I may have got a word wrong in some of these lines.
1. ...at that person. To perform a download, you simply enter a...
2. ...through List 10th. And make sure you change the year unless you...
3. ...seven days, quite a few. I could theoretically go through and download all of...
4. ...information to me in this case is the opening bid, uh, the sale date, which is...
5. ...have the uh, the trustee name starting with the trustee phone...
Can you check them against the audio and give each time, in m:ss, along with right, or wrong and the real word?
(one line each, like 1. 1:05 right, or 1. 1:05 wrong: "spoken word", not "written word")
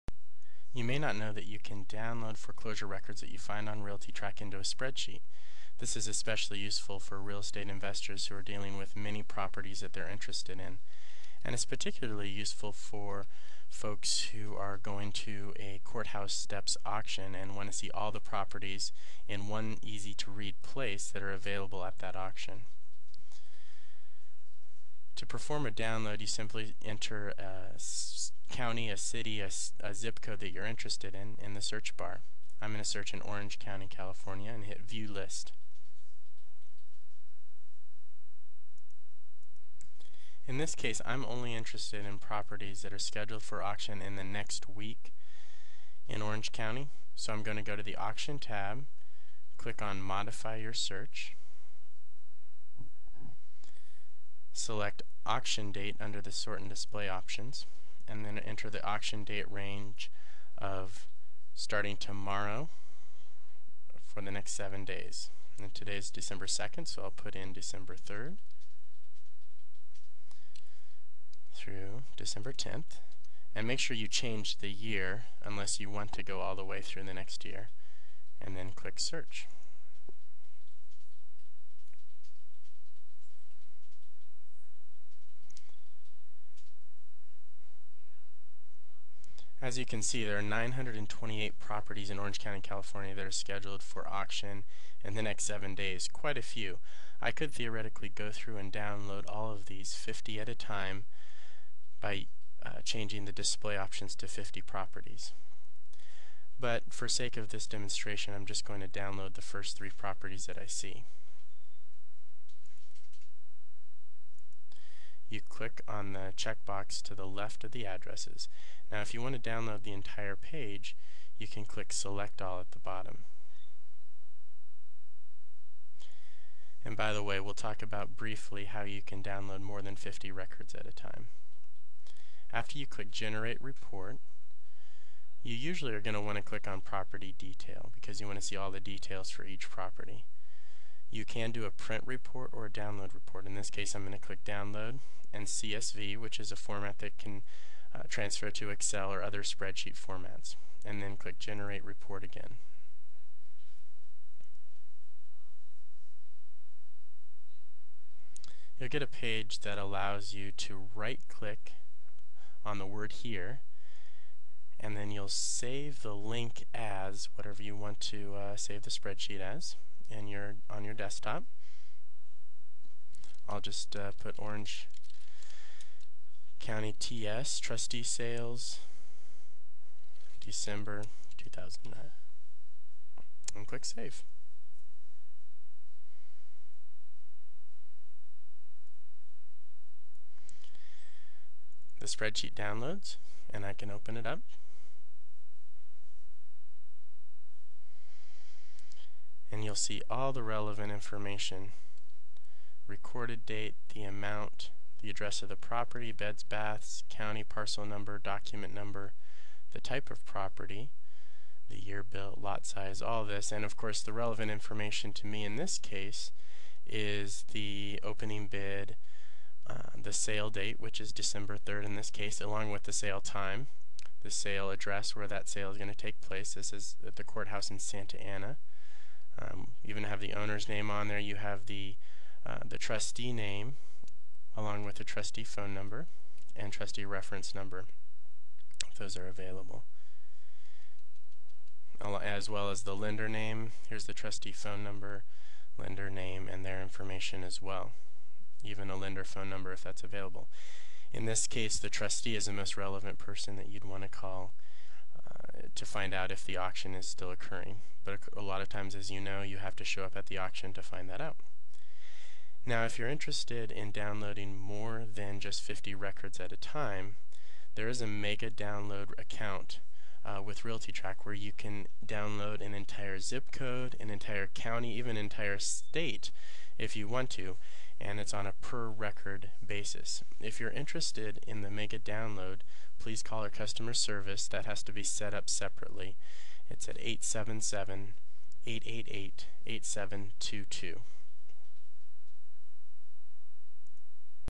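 1. 0:21 wrong: "auction", not "person"
2. 1:11 wrong: "December", not "List"
3. 1:35 right
4. 3:34 right
5. 3:51 wrong: "along", not "starting".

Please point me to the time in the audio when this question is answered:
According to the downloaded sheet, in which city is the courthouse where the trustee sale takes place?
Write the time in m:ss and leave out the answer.
3:47.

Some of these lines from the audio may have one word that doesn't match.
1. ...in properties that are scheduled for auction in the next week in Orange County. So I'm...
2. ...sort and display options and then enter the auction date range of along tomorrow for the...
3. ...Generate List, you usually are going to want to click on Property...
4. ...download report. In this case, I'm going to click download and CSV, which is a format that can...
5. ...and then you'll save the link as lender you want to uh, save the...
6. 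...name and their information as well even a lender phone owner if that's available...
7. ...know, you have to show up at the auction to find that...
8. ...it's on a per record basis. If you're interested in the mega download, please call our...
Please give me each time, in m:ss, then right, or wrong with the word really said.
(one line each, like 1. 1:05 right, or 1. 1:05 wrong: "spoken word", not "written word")
1. 0:42 right
2. 0:56 wrong: "starting", not "along"
3. 2:13 wrong: "Report", not "List"
4. 2:22 right
5. 2:44 wrong: "whatever", not "lender"
6. 4:06 wrong: "number", not "owner"
7. 4:19 right
8. 4:38 right.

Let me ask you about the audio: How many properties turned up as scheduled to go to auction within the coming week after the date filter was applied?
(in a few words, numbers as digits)
928.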